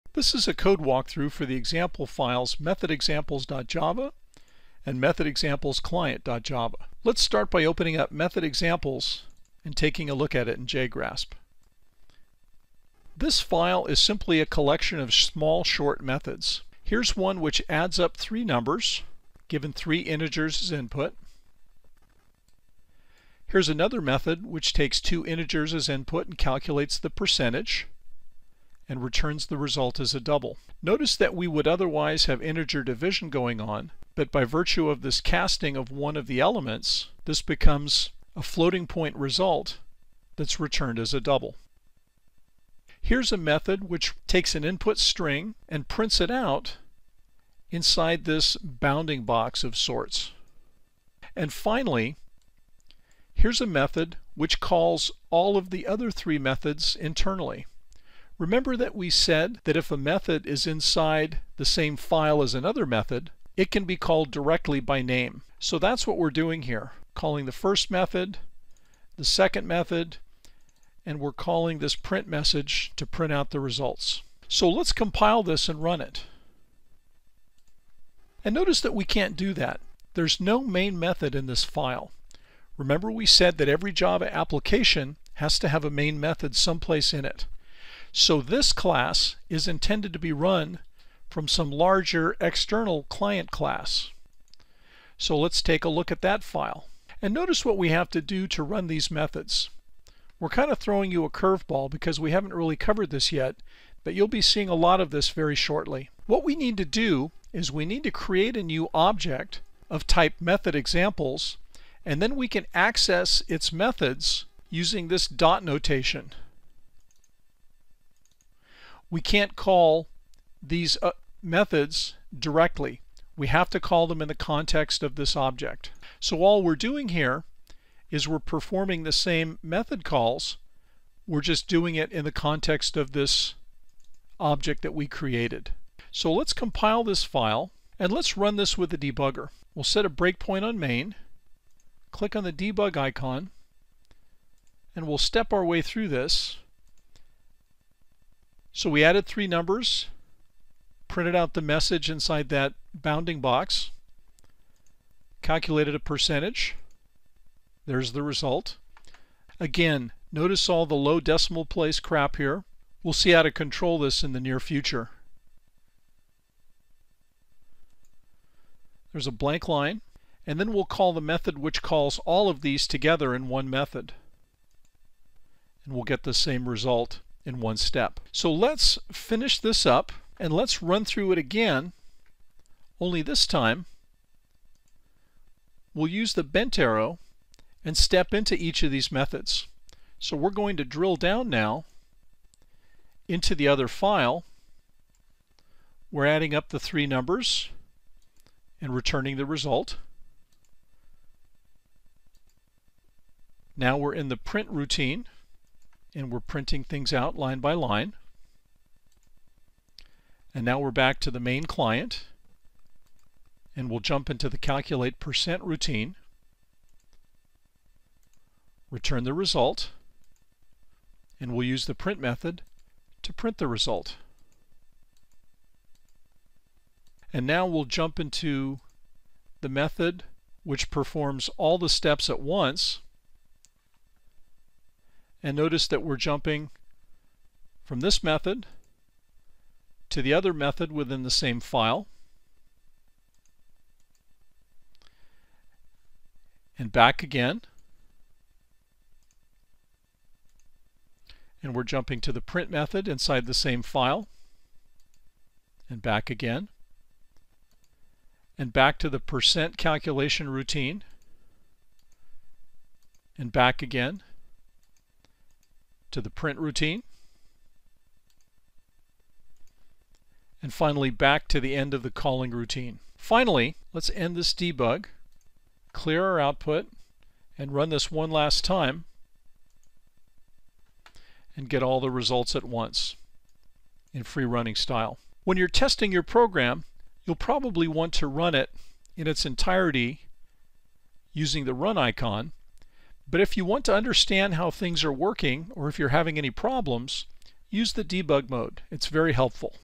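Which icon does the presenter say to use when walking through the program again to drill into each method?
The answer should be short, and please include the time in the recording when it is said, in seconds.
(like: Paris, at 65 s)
the bent arrow, at 186 s.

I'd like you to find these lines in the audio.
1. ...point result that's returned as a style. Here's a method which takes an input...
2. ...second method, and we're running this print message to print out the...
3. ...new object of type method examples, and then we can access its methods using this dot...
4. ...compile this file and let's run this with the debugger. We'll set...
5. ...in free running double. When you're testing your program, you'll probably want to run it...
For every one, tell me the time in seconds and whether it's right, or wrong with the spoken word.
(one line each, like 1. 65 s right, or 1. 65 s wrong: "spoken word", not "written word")
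1. 38 s wrong: "double", not "style"
2. 69 s wrong: "calling", not "running"
3. 108 s right
4. 136 s right
5. 284 s wrong: "style", not "double".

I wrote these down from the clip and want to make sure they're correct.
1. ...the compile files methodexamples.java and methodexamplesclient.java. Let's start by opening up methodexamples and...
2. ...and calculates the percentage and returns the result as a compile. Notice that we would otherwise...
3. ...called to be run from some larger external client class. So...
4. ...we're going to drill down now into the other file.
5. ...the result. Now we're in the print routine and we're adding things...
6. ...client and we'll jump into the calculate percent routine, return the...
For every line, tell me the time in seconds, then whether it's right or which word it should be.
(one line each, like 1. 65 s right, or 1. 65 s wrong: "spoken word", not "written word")
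1. 1 s wrong: "example", not "compile"
2. 26 s wrong: "double", not "compile"
3. 89 s wrong: "intended", not "called"
4. 190 s right
5. 199 s wrong: "printing", not "adding"
6. 211 s right.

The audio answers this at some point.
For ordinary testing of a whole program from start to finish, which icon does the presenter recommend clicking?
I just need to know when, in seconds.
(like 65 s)
291 s.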